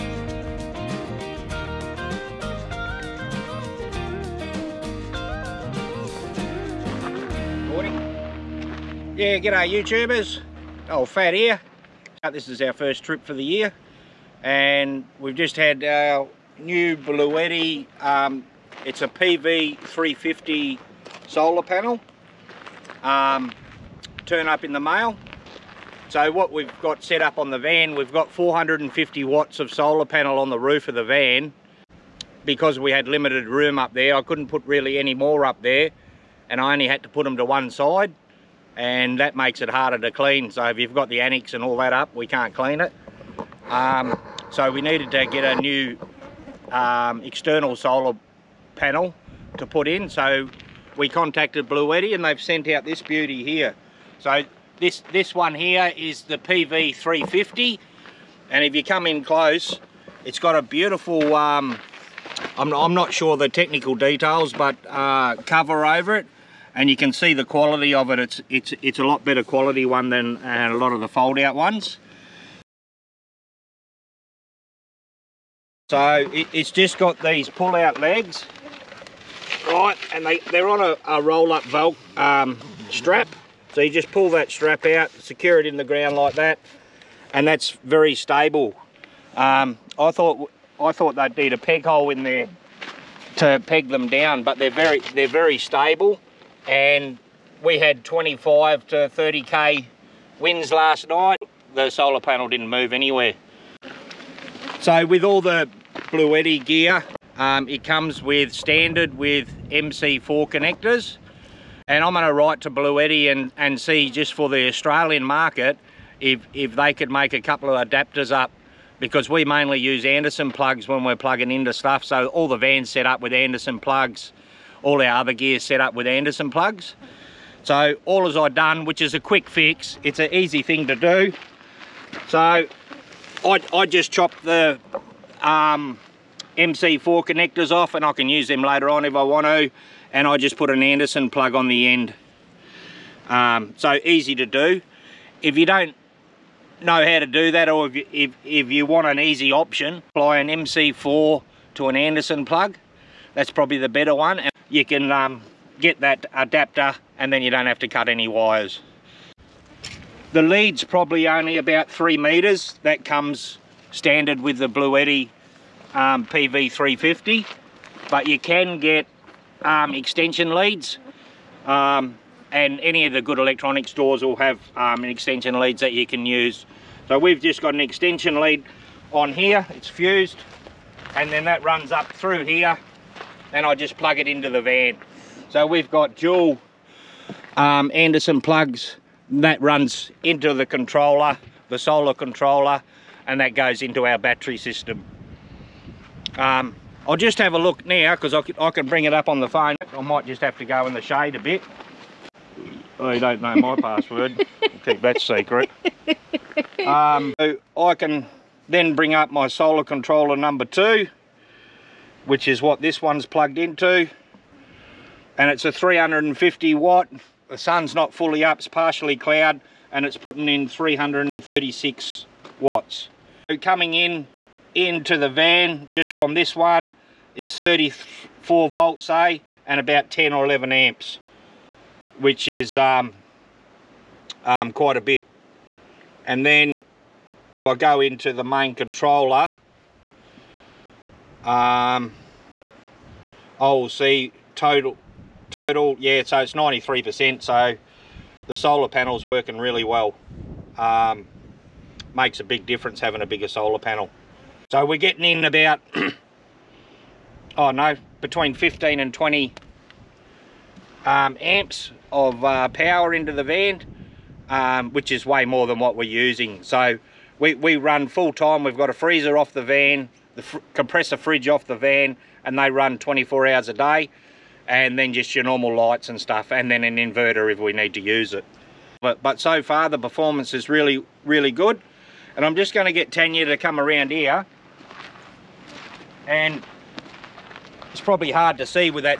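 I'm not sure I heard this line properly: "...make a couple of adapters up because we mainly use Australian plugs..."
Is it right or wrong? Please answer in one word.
wrong.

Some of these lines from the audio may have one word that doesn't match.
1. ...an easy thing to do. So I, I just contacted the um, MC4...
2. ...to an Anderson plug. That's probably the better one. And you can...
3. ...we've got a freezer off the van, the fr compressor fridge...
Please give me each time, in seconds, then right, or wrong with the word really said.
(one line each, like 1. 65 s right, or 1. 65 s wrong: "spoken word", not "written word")
1. 130 s wrong: "chopped", not "contacted"
2. 151 s right
3. 268 s right.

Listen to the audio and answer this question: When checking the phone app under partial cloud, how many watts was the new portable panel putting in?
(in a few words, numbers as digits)
336 watts.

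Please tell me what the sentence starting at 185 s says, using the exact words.
So we've got dual um, Anderson plugs that runs into the controller, the solar controller, and that goes into our battery system.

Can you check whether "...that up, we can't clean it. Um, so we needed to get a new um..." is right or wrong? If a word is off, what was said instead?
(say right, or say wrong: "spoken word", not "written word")
right.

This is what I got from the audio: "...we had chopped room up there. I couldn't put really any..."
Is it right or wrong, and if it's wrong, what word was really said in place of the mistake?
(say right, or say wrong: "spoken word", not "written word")
wrong: "limited", not "chopped".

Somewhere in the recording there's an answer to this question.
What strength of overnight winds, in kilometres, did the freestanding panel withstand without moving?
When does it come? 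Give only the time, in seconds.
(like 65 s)
98 s.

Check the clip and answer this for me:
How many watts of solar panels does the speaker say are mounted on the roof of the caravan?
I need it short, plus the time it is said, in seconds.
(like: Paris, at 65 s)
450 watts, at 28 s.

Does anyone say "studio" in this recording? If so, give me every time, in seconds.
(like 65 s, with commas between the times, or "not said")
not said.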